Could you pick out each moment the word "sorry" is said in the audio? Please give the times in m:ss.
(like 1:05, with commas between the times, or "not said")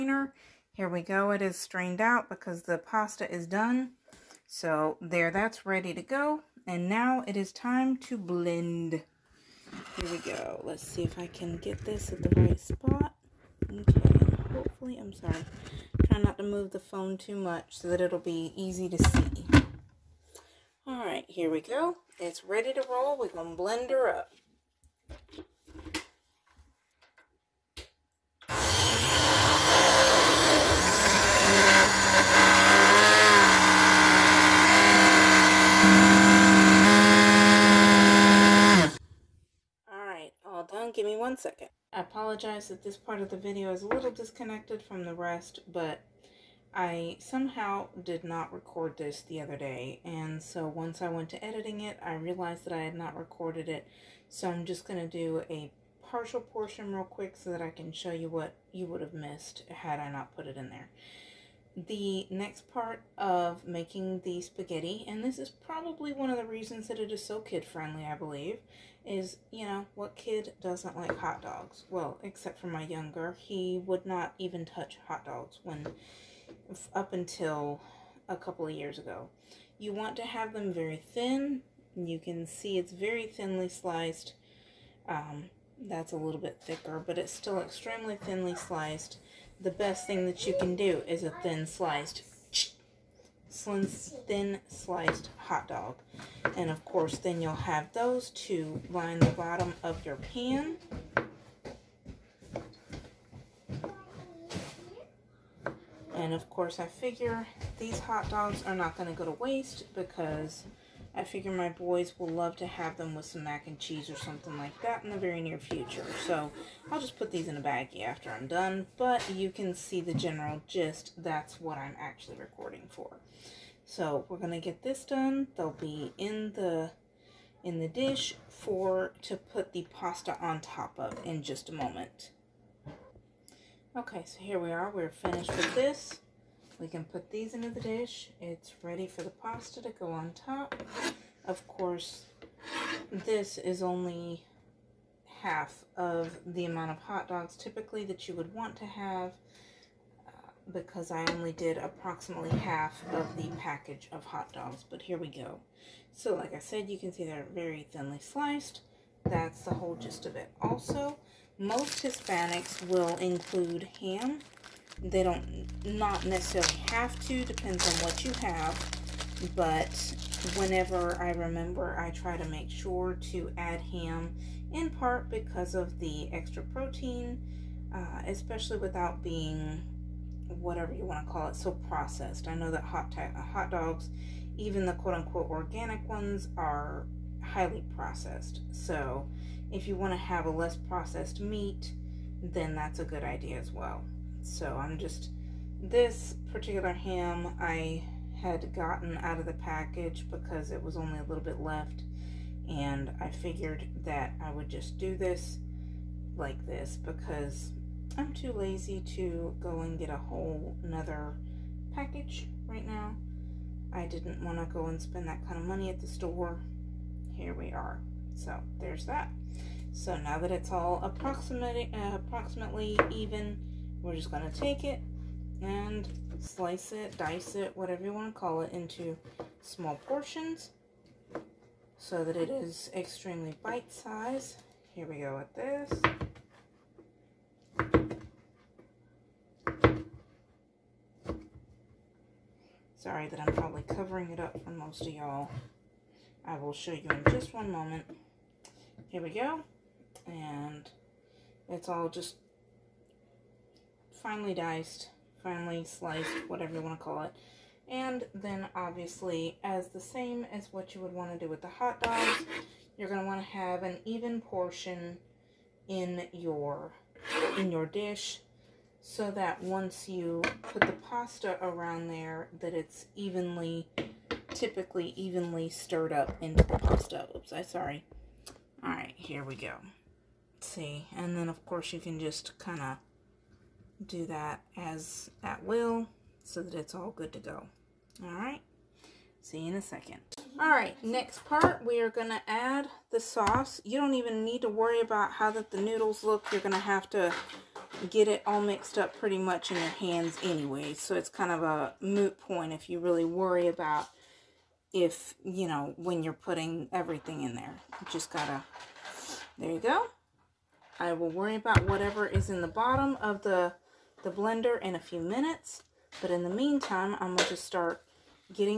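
0:15, 4:02, 4:37.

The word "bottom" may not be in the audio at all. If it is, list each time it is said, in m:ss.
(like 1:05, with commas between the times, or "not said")
1:39, 5:12.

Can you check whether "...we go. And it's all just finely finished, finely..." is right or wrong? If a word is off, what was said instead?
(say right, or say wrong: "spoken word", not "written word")
wrong: "diced", not "finished".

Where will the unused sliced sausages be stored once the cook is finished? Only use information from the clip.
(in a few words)
a baggie.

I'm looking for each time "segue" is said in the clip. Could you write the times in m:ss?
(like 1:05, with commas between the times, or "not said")
not said.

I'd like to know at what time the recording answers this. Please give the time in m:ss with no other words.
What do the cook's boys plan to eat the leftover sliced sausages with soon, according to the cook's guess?
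1:53.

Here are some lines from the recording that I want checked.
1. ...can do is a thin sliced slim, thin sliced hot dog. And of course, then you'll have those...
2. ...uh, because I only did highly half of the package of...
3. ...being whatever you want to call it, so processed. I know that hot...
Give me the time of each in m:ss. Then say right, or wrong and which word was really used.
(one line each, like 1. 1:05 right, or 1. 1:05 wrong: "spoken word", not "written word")
1. 1:30 right
2. 2:30 wrong: "approximately", not "highly"
3. 2:59 right.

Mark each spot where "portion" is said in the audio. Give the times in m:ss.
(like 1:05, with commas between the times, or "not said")
0:56, 3:50, 4:24.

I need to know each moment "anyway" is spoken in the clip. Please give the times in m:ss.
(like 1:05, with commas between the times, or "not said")
5:00.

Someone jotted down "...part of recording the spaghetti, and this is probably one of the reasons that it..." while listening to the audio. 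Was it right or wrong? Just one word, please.
wrong.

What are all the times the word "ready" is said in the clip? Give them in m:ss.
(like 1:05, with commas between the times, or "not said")
0:05, 0:22, 2:18.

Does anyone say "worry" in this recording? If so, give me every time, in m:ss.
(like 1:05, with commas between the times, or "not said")
4:54, 5:03, 5:11.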